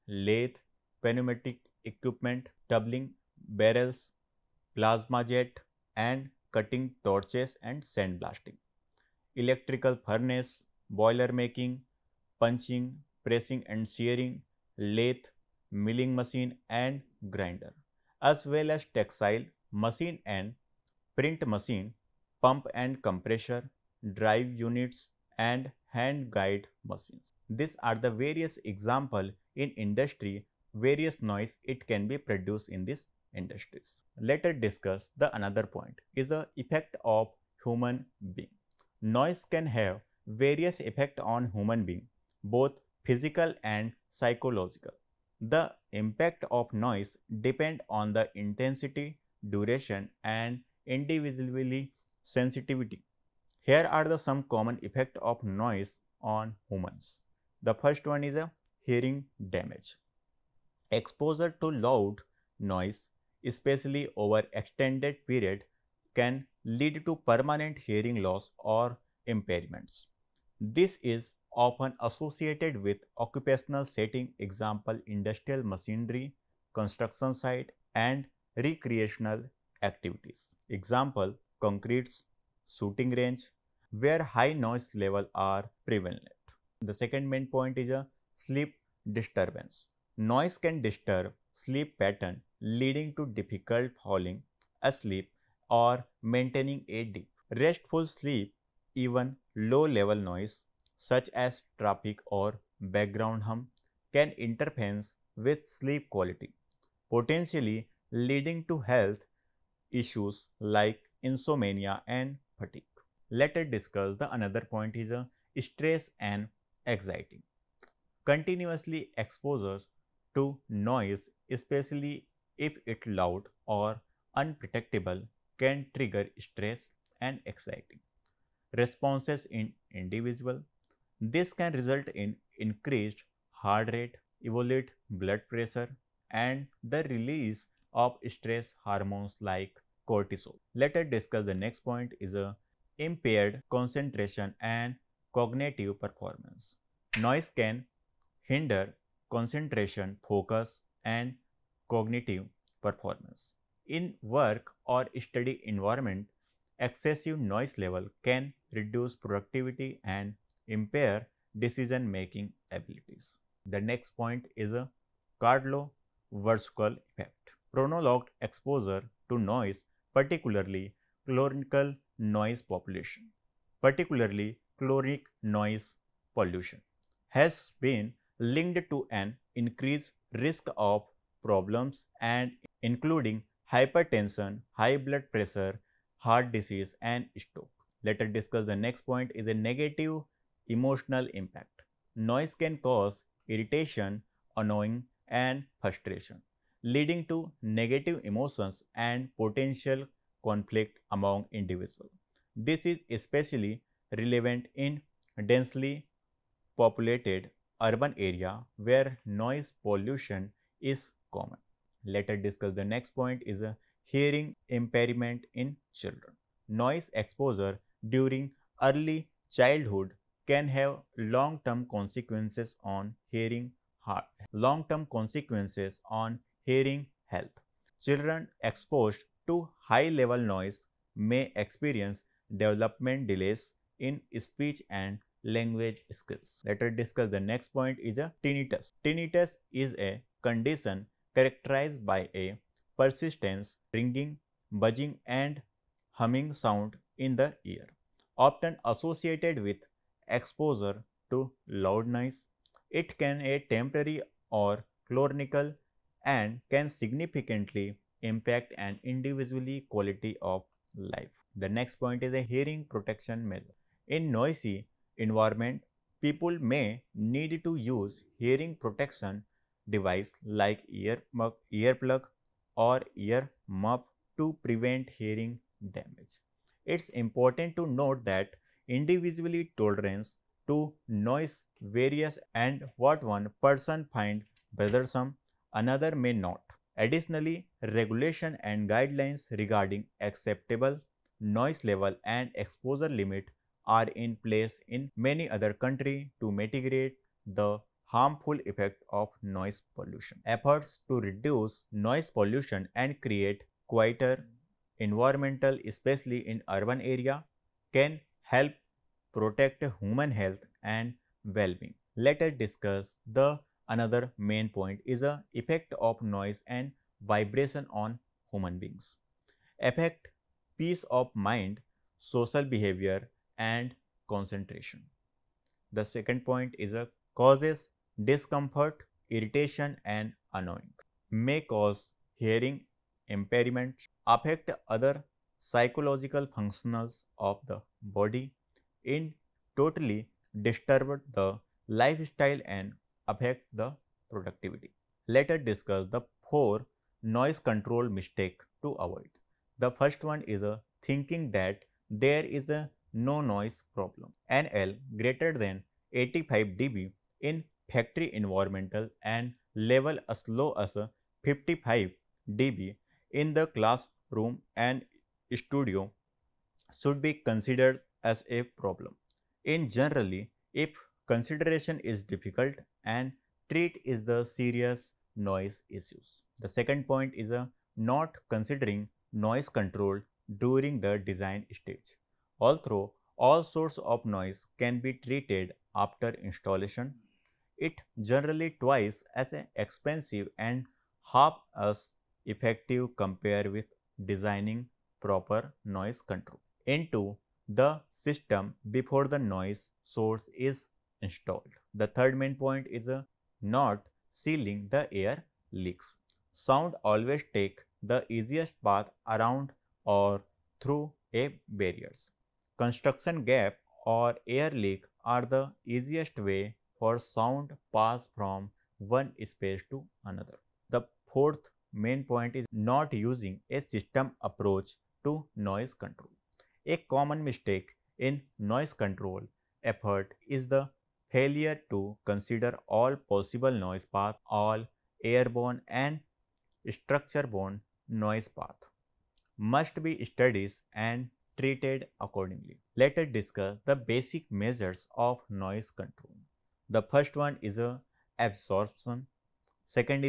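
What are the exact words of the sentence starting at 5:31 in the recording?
May cause hearing impairment, affect other psychological functions of the body, in totally disturb the lifestyle and affect the productivity.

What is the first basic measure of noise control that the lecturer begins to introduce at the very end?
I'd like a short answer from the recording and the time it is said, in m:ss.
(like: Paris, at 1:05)
absorption, at 7:28.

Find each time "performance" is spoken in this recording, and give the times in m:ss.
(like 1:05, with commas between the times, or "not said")
2:25, 2:32.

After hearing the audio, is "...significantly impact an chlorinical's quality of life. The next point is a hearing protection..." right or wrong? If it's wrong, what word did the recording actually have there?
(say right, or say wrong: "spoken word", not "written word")
wrong: "individual", not "chlorinical".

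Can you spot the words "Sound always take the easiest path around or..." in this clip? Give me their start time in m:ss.
6:46.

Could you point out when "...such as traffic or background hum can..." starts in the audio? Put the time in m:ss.
1:40.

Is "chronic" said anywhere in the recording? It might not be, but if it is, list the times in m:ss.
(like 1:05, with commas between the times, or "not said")
2:54, 4:15.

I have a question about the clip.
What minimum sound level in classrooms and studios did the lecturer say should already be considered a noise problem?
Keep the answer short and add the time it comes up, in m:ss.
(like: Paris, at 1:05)
55 dB, at 6:01.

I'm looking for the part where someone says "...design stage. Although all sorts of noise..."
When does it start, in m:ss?
6:21.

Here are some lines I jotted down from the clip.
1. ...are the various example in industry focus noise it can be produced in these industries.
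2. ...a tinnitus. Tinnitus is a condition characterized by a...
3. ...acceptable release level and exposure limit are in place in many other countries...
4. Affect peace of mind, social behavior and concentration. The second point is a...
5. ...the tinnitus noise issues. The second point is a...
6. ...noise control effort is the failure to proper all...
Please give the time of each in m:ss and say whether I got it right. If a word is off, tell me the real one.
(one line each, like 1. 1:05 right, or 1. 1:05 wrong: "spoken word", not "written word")
1. 0:27 wrong: "various", not "focus"
2. 3:58 right
3. 4:50 wrong: "noise", not "release"
4. 5:19 right
5. 6:14 wrong: "serious", not "tinnitus"
6. 7:08 wrong: "consider", not "proper".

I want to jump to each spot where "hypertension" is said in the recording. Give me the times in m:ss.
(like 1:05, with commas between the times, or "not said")
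3:03.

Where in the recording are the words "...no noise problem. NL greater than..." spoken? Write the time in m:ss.
5:53.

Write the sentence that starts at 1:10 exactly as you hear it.
This is often associated with occupational setting example industrial machinery, construction site and recreational activities.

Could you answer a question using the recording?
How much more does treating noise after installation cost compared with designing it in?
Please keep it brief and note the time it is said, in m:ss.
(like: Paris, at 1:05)
twice as expensive, at 6:28.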